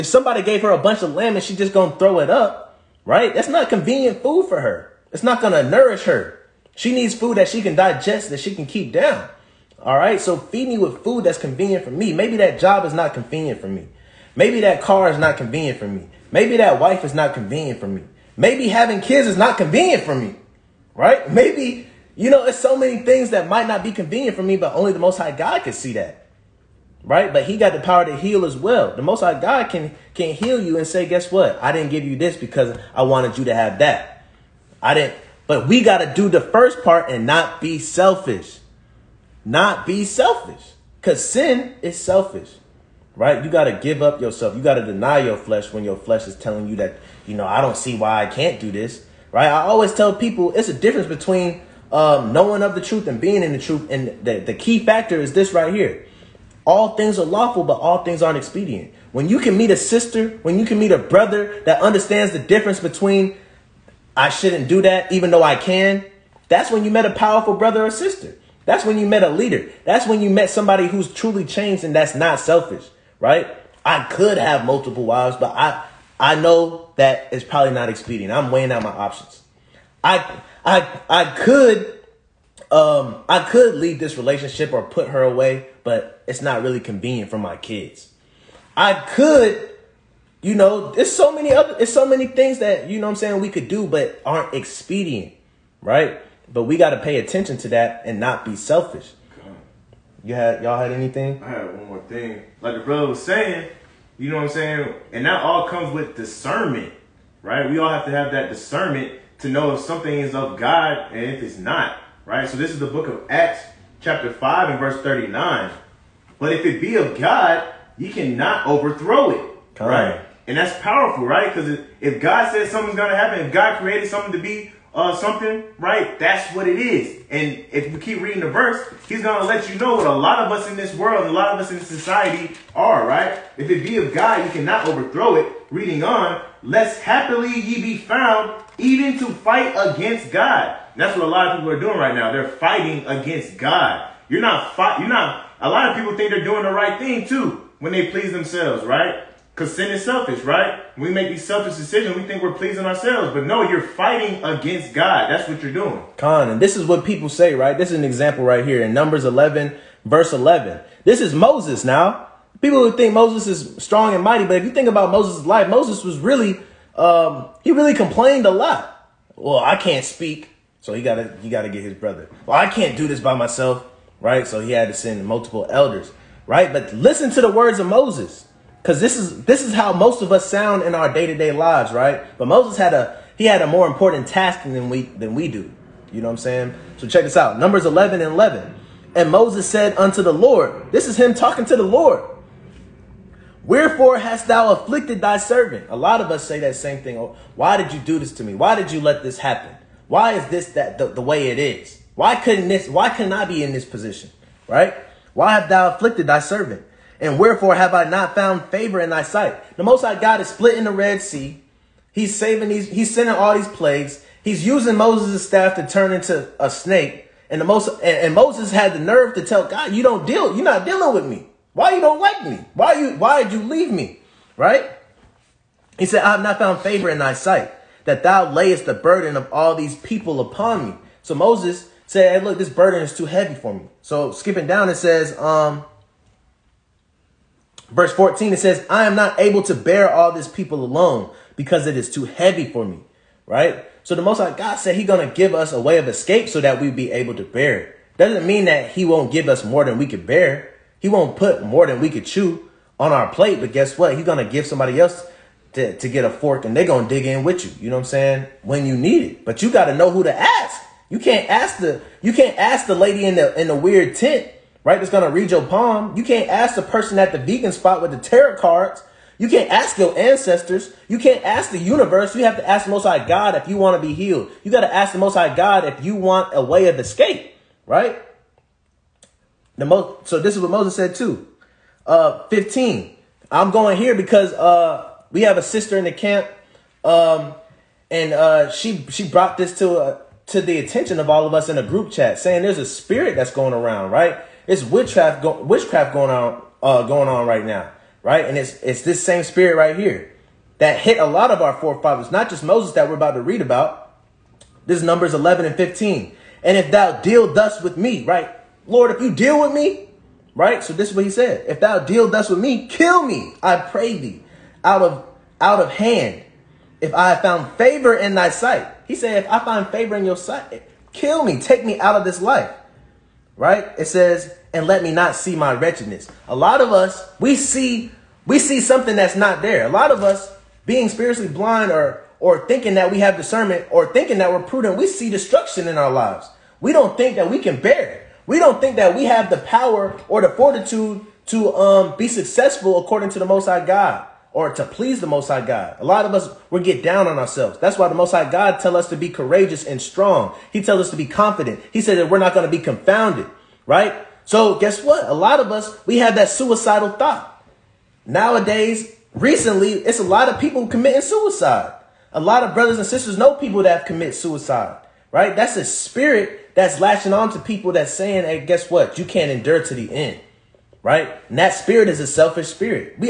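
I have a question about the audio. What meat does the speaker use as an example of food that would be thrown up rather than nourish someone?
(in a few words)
Lamb.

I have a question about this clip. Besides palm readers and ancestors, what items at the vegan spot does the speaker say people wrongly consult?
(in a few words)
Tarot cards.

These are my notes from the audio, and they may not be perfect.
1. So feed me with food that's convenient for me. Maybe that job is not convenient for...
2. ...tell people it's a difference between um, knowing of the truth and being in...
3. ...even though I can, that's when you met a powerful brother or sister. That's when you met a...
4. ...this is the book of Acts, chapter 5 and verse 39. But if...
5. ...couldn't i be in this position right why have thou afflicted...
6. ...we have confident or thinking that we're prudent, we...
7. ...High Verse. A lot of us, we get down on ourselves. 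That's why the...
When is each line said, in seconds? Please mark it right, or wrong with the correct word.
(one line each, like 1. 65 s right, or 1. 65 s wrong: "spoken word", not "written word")
1. 10 s right
2. 49 s right
3. 65 s right
4. 112 s right
5. 203 s right
6. 333 s wrong: "discernment", not "confident"
7. 345 s wrong: "God", not "Verse".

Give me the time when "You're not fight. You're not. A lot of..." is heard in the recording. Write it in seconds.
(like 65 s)
144 s.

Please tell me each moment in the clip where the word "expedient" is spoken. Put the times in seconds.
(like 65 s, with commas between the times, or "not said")
58 s, 77 s, 94 s.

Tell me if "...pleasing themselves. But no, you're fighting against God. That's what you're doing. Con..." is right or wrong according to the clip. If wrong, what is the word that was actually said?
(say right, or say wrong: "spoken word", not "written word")
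wrong: "ourselves", not "themselves".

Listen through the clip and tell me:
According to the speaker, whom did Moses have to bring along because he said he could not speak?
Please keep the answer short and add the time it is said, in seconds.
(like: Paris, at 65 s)
His brother, at 171 s.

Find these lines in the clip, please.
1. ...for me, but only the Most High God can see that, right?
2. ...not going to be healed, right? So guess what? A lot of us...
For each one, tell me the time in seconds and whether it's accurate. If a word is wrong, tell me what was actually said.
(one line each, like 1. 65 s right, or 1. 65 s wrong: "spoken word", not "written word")
1. 24 s right
2. 352 s wrong: "confounded", not "healed".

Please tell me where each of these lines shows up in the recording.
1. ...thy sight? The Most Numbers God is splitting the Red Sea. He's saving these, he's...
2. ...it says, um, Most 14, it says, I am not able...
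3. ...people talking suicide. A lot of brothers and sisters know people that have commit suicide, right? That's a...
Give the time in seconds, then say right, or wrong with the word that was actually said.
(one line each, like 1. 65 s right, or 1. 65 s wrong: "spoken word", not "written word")
1. 209 s wrong: "High", not "Numbers"
2. 234 s wrong: "Verse", not "Most"
3. 360 s wrong: "committing", not "talking".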